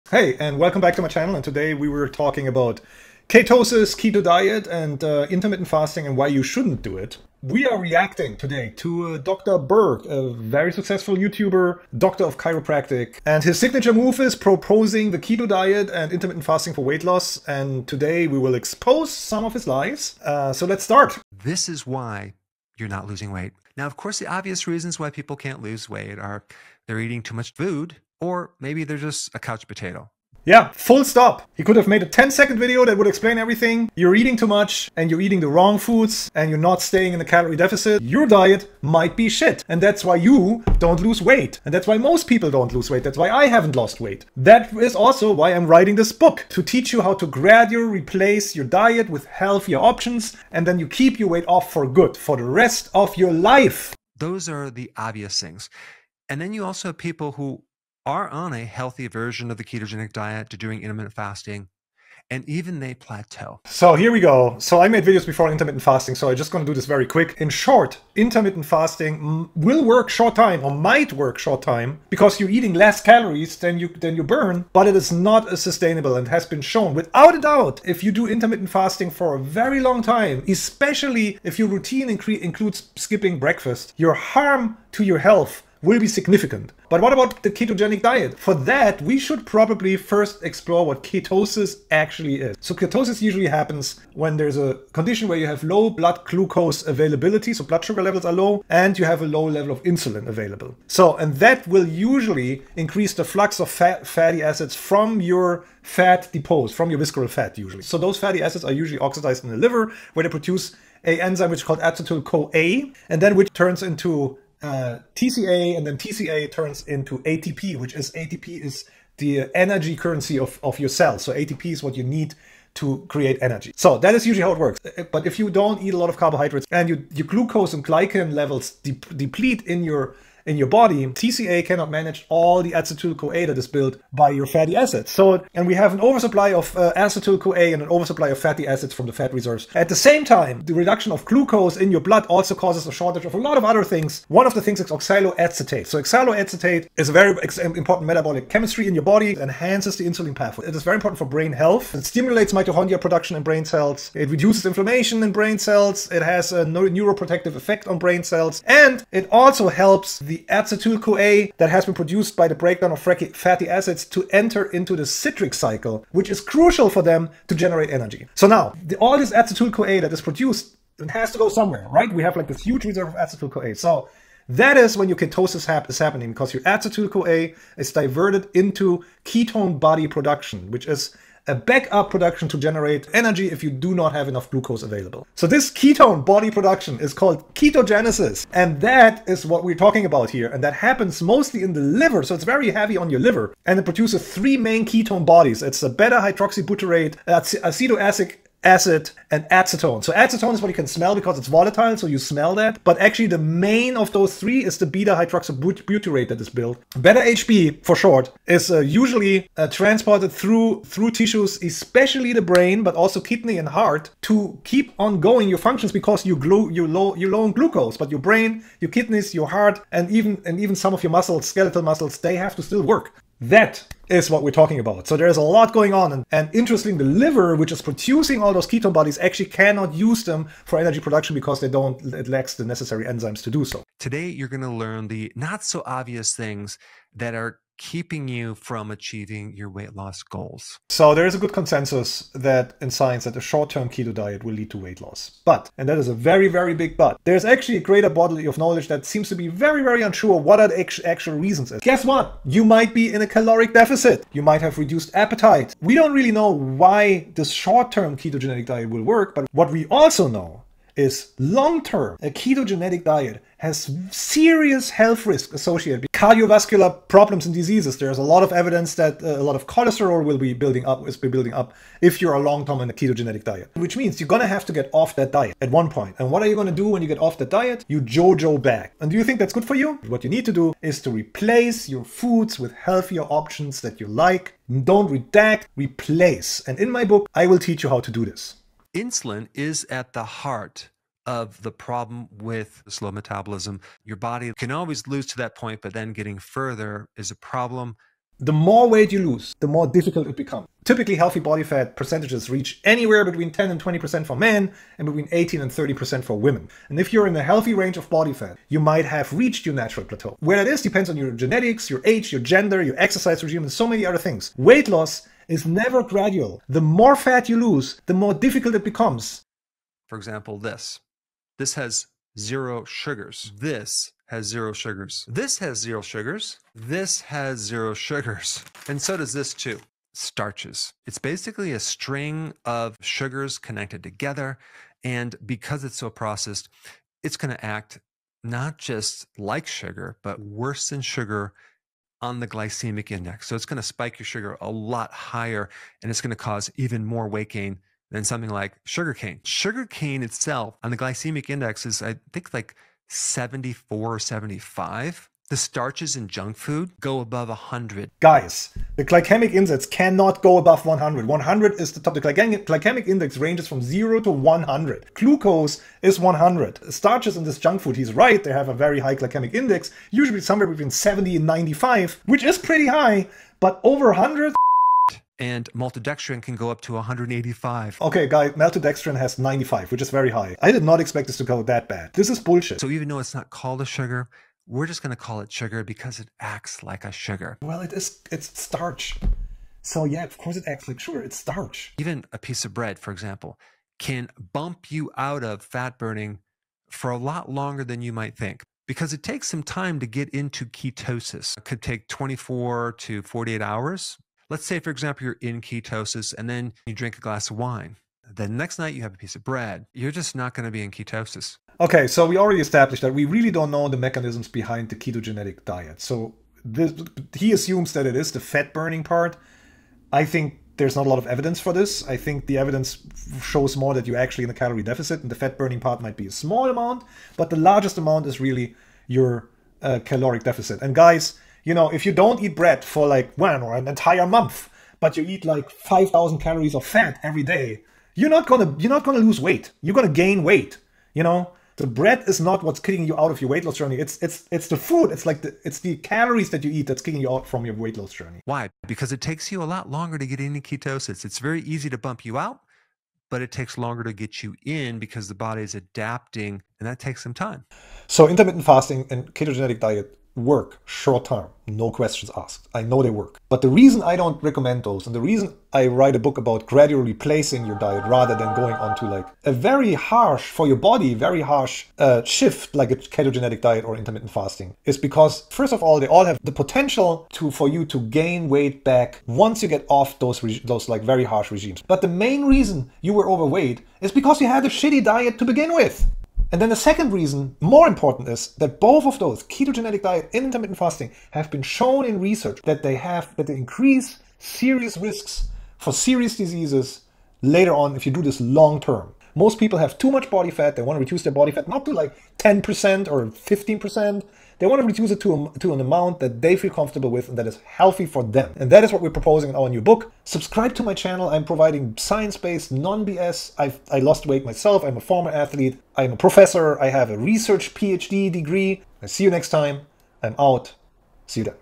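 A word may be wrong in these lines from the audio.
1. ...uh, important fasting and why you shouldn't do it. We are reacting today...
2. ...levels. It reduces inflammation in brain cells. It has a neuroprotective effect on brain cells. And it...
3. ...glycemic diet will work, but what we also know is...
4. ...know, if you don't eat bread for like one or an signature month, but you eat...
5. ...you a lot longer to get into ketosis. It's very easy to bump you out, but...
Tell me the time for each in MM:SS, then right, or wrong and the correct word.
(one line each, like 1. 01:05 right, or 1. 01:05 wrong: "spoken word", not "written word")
1. 00:05 wrong: "intermittent", not "important"
2. 02:33 wrong: "cells", not "levels"
3. 04:18 wrong: "ketogenic", not "glycemic"
4. 07:11 wrong: "entire", not "signature"
5. 07:29 right.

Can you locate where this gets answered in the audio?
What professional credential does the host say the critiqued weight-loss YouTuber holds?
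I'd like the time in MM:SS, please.
00:11.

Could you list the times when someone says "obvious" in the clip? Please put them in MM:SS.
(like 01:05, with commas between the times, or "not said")
00:24, 00:54, 03:55.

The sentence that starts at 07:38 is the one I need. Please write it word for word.
So intermittent fasting and ketogenic diet work short term, no questions asked.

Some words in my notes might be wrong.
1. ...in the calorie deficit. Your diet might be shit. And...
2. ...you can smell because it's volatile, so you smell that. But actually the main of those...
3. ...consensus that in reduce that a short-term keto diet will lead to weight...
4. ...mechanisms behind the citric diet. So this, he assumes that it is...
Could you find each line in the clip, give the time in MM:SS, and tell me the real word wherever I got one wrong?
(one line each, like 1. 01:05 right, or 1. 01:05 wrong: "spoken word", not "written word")
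1. 00:37 right
2. 03:20 right
3. 04:01 wrong: "science", not "reduce"
4. 06:53 wrong: "ketogenic", not "citric".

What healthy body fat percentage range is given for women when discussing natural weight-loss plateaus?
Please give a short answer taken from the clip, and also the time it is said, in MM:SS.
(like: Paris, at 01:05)
18 to 30%, at 05:05.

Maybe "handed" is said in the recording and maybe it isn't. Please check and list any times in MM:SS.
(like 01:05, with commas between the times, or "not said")
not said.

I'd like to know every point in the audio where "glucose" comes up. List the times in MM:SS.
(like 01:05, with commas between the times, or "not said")
01:36, 02:07, 02:21, 03:04, 03:37, 06:05.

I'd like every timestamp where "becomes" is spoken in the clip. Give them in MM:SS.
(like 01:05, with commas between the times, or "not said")
05:00, 05:18.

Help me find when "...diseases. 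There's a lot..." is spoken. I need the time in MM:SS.
04:27.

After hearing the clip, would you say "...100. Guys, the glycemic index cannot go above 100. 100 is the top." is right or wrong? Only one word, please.
right.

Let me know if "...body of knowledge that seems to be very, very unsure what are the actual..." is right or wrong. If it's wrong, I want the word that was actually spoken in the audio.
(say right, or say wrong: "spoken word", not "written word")
right.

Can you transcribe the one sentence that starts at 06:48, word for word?
The next night you have a piece of bread.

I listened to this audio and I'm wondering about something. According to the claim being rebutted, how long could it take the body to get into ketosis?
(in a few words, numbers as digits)
24 to 48 hours.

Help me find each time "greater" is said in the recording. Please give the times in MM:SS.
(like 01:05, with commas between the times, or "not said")
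04:07.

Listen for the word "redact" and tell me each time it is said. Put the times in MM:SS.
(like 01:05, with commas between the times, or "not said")
04:45.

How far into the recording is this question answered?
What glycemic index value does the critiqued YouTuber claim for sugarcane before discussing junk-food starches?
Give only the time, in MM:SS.
05:53.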